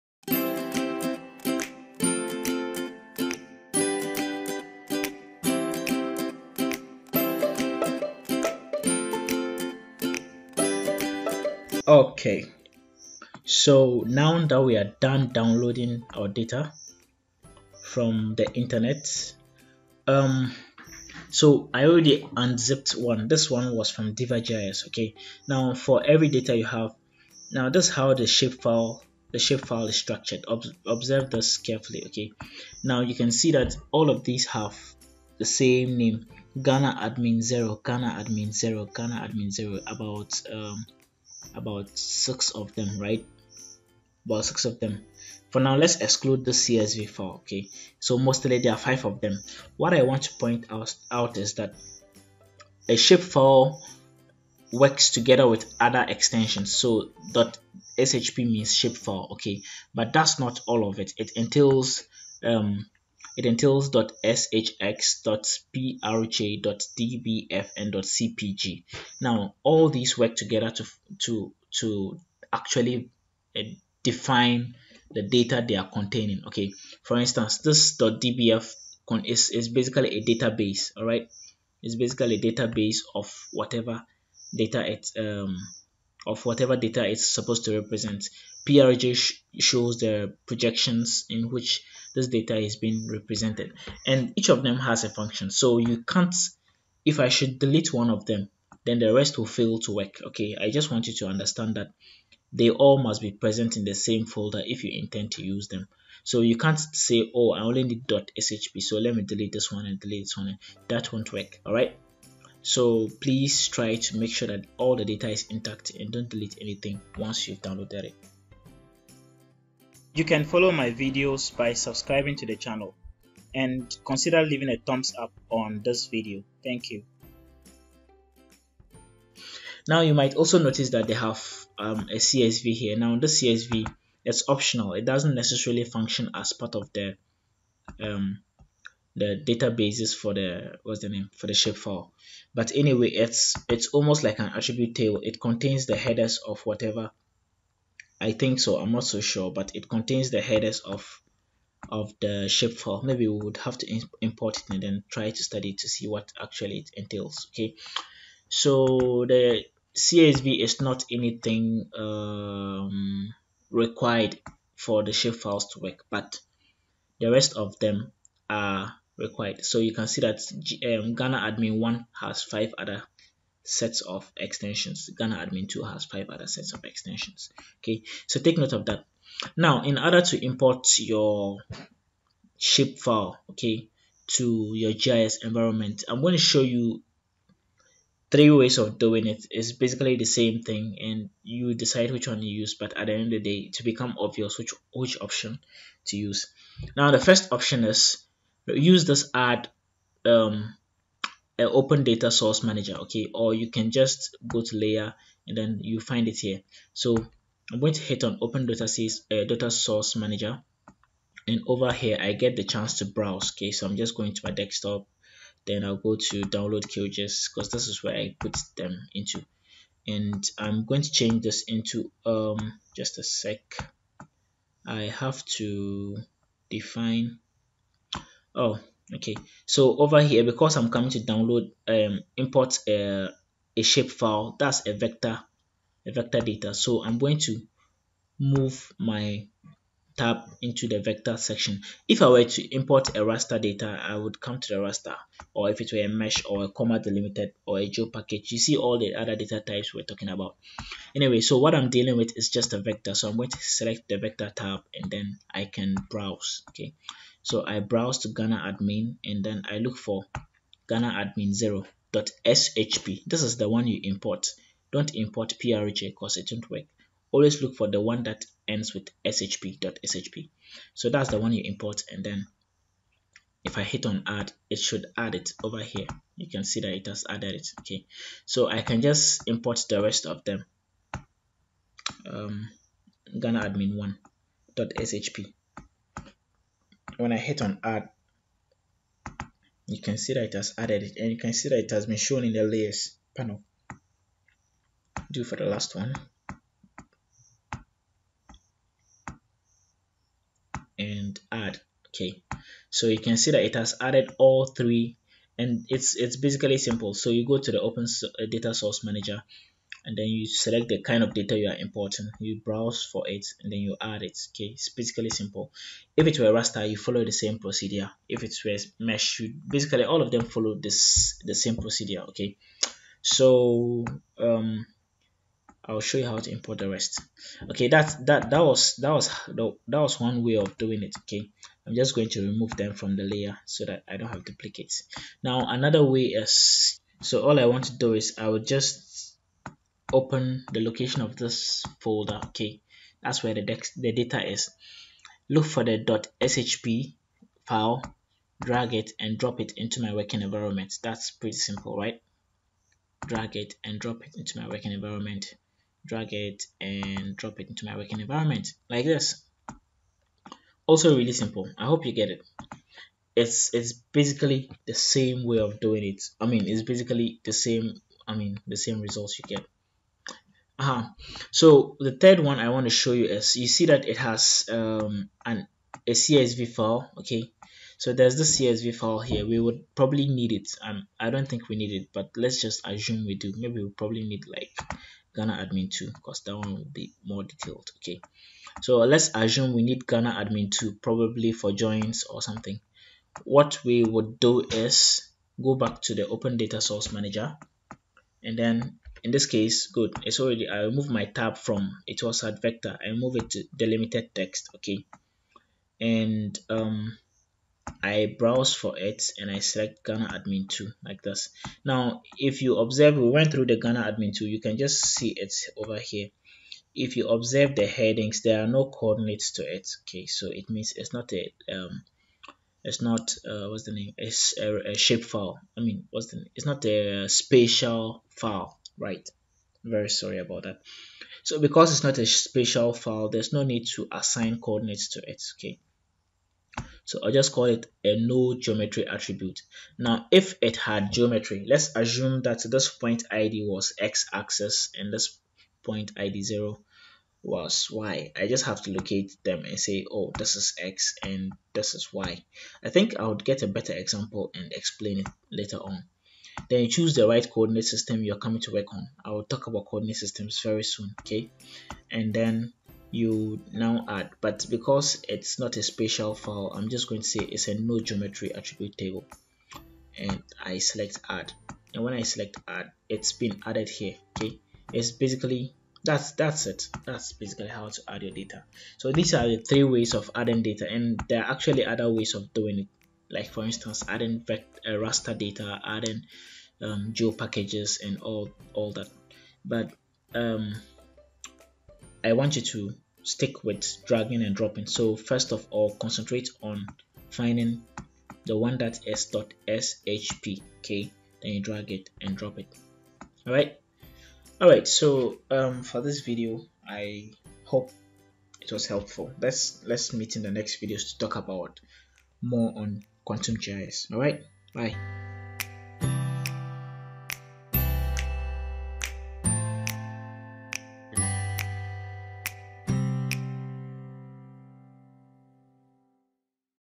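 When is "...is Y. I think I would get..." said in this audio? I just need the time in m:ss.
7:31.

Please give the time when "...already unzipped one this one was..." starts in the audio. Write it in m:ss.
0:21.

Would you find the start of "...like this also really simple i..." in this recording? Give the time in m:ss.
5:58.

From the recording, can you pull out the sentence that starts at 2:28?
I'm not so sure, but it contains the headers of of the shapefile.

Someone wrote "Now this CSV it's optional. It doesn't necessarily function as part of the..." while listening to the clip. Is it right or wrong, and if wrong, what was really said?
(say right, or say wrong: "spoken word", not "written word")
right.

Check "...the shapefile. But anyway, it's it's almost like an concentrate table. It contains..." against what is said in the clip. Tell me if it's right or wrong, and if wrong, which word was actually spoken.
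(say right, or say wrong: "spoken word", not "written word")
wrong: "attribute", not "concentrate".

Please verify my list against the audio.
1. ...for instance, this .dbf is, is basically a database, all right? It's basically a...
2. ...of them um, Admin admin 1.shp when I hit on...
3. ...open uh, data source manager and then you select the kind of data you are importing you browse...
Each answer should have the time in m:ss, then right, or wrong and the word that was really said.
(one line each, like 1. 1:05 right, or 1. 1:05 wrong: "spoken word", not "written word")
1. 1:17 right
2. 4:40 wrong: "Ghana", not "Admin"
3. 5:07 right.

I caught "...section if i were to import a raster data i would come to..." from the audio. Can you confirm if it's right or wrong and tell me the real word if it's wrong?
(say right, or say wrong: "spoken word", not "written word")
right.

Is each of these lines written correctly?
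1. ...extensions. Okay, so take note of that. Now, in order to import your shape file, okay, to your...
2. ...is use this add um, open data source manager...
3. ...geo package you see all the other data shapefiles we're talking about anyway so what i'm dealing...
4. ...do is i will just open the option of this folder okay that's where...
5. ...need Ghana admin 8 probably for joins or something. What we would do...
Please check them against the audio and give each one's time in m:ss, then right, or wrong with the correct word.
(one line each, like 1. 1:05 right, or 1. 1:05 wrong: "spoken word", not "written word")
1. 2:56 right
2. 3:17 right
3. 4:07 wrong: "types", not "shapefiles"
4. 5:37 wrong: "location", not "option"
5. 6:29 wrong: "2", not "8".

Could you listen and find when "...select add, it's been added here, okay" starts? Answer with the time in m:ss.
7:52.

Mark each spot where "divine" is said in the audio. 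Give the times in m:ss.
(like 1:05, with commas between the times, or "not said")
not said.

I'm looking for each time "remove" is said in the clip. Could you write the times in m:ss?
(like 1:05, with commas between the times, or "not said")
5:32, 6:40.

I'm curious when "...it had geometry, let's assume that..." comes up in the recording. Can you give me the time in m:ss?
7:20.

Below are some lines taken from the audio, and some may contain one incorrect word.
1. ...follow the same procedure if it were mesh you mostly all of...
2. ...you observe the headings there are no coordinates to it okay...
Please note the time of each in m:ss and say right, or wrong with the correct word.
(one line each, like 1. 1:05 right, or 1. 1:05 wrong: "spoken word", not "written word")
1. 5:16 wrong: "basically", not "mostly"
2. 6:57 right.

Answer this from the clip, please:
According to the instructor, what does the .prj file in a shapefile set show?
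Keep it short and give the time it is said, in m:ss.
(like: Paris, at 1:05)
Projections, at 1:30.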